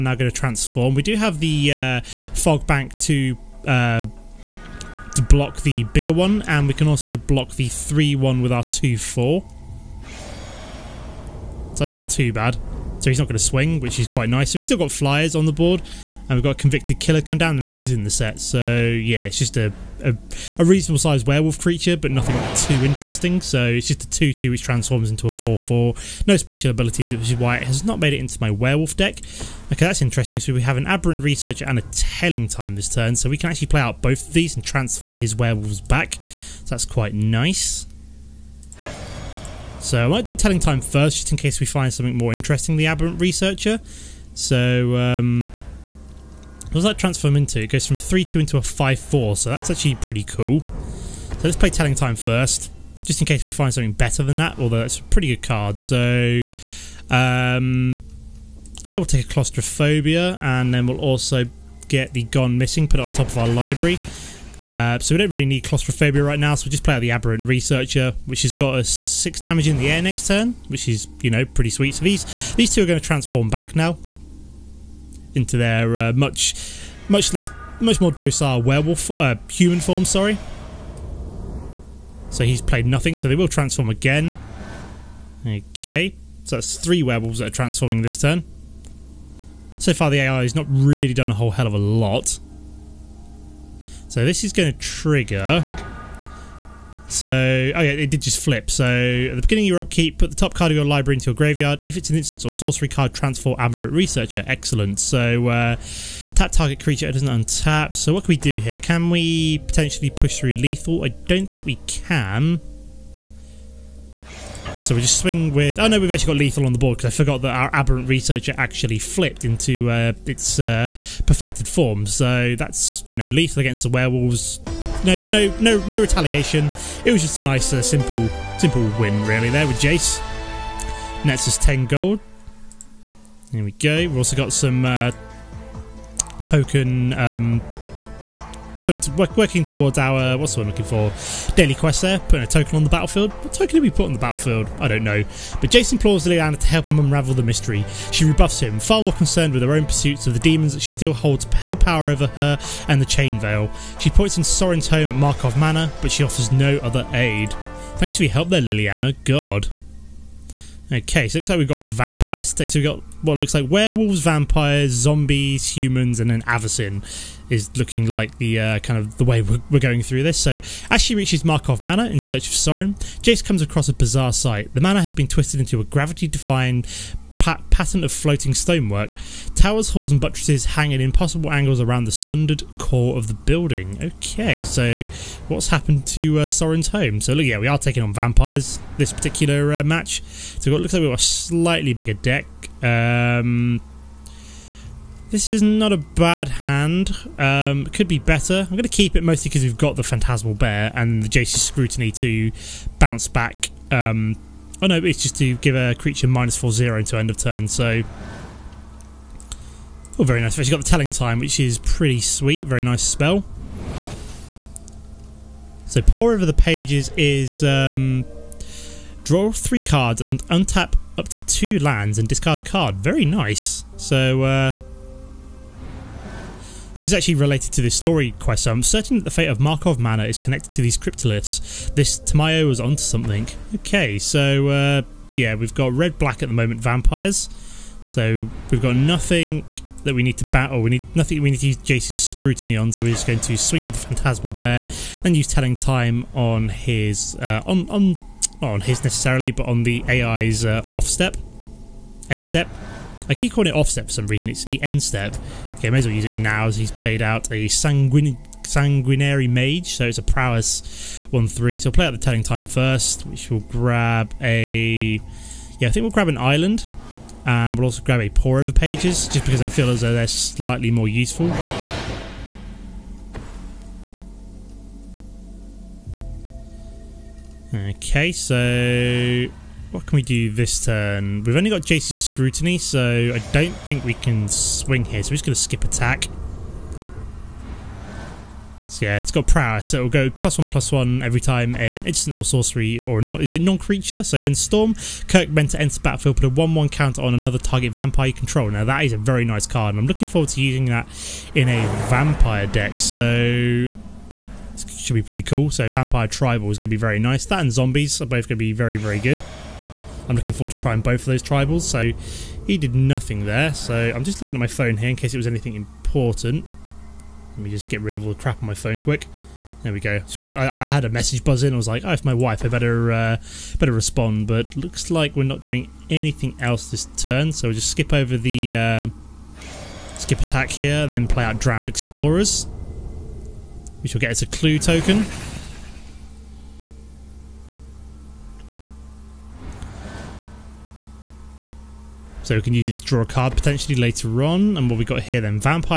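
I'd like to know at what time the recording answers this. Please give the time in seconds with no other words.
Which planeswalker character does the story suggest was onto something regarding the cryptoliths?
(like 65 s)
232 s.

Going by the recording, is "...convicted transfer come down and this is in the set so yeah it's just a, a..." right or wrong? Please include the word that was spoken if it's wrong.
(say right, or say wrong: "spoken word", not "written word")
wrong: "killer", not "transfer".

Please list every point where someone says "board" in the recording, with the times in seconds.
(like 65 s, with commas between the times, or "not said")
15 s, 116 s.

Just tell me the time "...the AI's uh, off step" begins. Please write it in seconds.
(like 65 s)
249 s.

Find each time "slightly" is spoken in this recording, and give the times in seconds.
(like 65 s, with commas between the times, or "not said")
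191 s, 270 s.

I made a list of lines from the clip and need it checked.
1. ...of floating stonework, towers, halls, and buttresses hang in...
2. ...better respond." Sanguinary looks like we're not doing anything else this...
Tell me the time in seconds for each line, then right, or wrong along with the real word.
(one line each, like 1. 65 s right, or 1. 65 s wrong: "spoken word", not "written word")
1. 178 s right
2. 323 s wrong: "But", not "Sanguinary".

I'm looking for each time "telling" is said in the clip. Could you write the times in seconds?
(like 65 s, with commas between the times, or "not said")
31 s, 40 s, 51 s, 210 s, 245 s, 262 s.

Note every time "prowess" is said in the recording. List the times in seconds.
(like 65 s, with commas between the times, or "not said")
260 s, 289 s.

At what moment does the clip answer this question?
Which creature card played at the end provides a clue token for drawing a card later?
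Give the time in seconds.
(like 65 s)
331 s.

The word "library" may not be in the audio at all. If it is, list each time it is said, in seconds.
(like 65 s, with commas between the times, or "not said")
63 s, 100 s.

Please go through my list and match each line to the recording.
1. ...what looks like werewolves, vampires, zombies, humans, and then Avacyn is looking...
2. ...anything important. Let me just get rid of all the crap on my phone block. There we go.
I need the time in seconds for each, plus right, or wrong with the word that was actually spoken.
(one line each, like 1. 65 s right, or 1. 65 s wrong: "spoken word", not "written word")
1. 163 s right
2. 315 s wrong: "quick", not "block".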